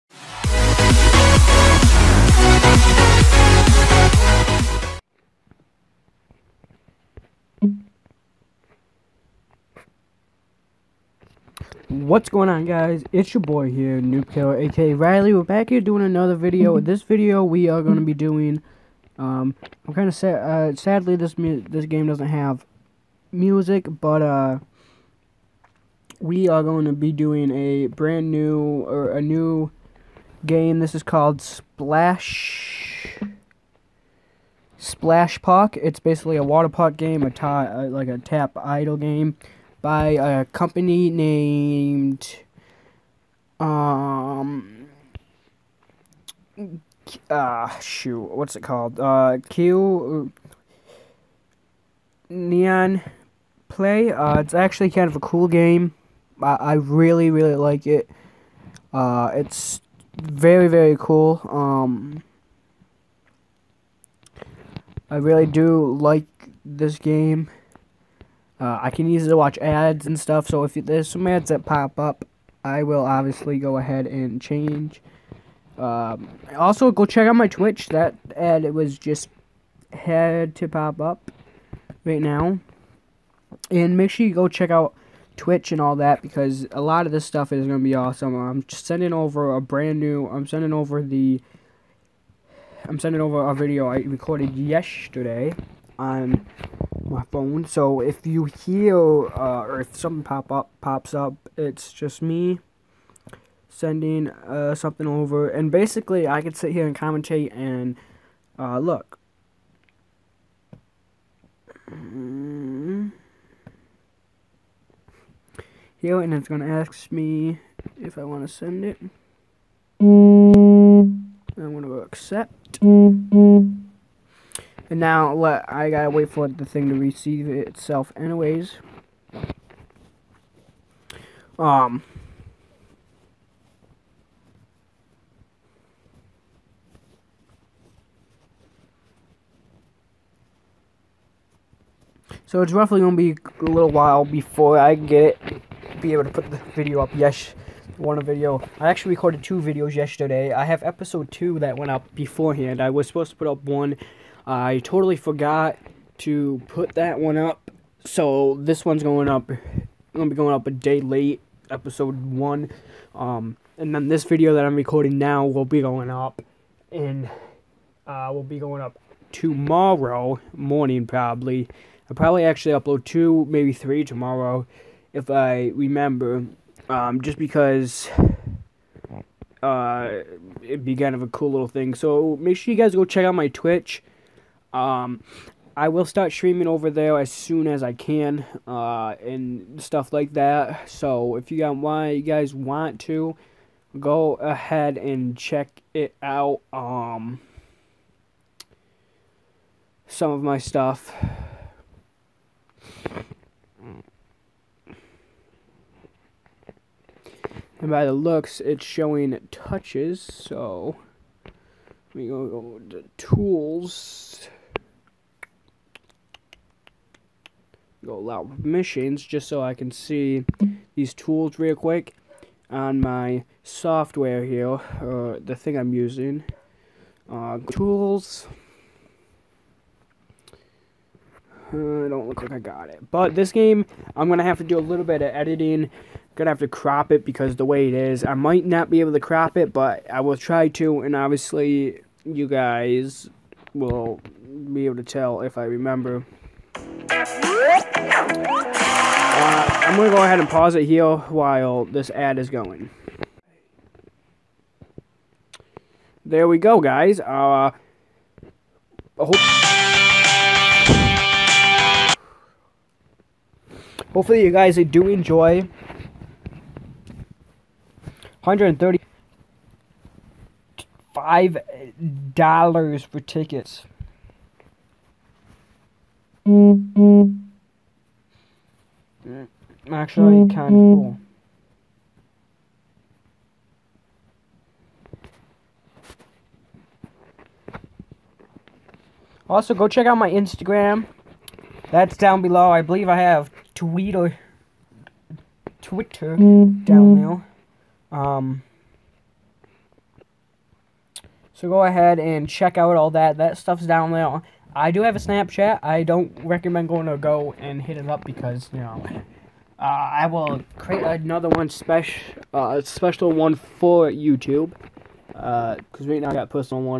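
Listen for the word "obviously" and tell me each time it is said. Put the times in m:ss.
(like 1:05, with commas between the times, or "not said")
1:13, 4:01.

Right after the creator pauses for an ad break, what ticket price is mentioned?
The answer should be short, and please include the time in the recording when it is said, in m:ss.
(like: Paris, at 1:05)
135 dollars, at 4:28.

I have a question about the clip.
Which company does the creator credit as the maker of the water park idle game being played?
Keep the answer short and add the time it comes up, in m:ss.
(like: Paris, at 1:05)
Neon Play, at 0:52.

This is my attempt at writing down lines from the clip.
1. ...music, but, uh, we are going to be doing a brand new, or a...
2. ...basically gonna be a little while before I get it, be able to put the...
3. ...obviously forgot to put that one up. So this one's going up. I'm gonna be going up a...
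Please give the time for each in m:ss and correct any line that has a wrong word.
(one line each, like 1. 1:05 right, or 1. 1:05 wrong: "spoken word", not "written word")
1. 0:23 right
2. 2:22 wrong: "roughly", not "basically"
3. 2:34 wrong: "totally", not "obviously".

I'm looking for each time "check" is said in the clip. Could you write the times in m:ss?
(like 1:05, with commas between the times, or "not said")
1:17, 1:24, 3:03, 3:15, 4:49, 5:02.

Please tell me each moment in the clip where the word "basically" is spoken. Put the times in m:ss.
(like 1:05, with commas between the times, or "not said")
0:35, 1:45.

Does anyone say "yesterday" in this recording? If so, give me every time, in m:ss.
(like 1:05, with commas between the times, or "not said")
1:34, 2:29.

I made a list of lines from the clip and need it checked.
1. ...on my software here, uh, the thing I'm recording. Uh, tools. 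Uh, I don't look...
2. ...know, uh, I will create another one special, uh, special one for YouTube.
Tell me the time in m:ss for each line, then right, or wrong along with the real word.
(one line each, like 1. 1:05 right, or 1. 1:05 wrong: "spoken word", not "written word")
1. 3:42 wrong: "using", not "recording"
2. 5:08 right.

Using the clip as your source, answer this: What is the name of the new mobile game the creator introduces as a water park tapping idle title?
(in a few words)
Splash Park.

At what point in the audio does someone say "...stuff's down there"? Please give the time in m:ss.
5:03.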